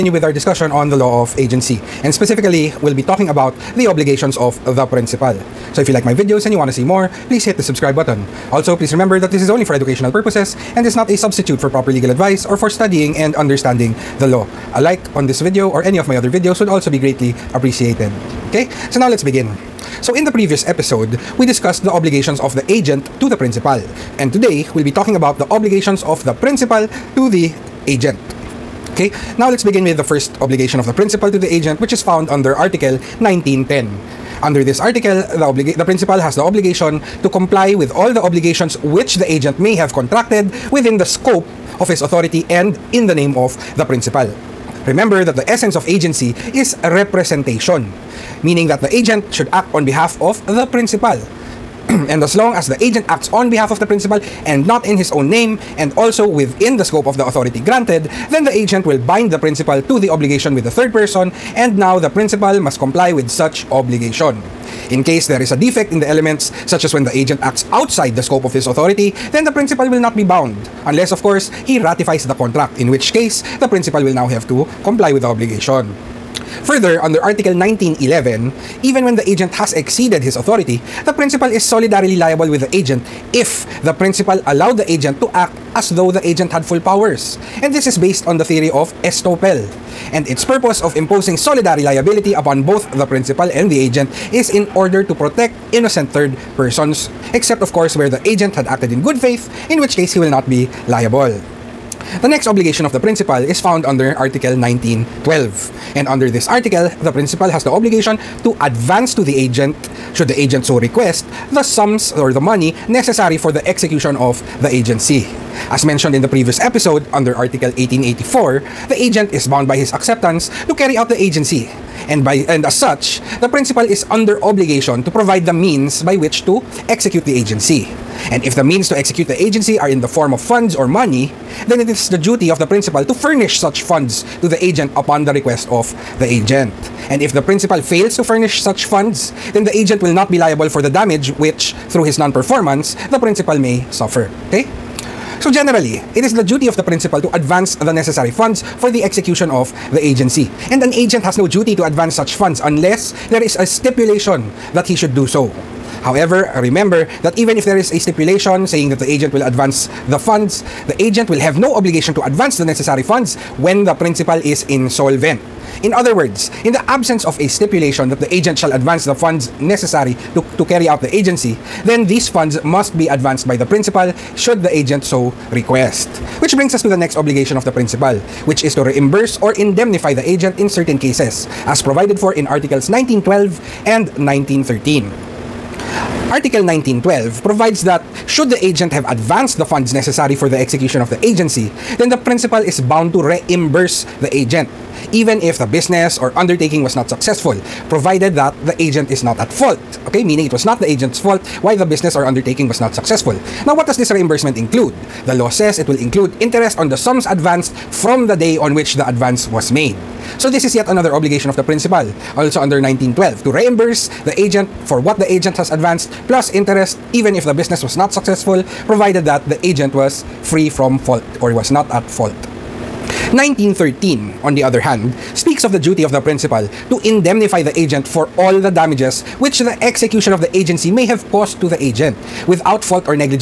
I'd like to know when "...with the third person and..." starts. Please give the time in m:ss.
1:00.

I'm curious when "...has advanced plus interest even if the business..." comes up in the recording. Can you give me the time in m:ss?
3:35.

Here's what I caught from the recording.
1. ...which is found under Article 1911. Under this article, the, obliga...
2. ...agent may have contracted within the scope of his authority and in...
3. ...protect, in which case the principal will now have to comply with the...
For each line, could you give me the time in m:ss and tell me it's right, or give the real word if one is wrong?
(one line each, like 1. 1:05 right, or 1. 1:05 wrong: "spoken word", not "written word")
1. 0:31 wrong: "1910", not "1911"
2. 0:39 right
3. 1:12 wrong: "contract", not "protect".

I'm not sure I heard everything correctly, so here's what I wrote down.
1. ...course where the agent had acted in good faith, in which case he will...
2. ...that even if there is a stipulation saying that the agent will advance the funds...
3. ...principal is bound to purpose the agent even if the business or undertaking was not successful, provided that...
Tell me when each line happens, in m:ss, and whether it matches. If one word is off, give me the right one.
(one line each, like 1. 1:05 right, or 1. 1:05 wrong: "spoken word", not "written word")
1. 1:37 right
2. 2:37 right
3. 3:12 wrong: "reimburse", not "purpose".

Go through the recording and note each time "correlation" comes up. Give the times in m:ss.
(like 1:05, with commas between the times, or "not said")
not said.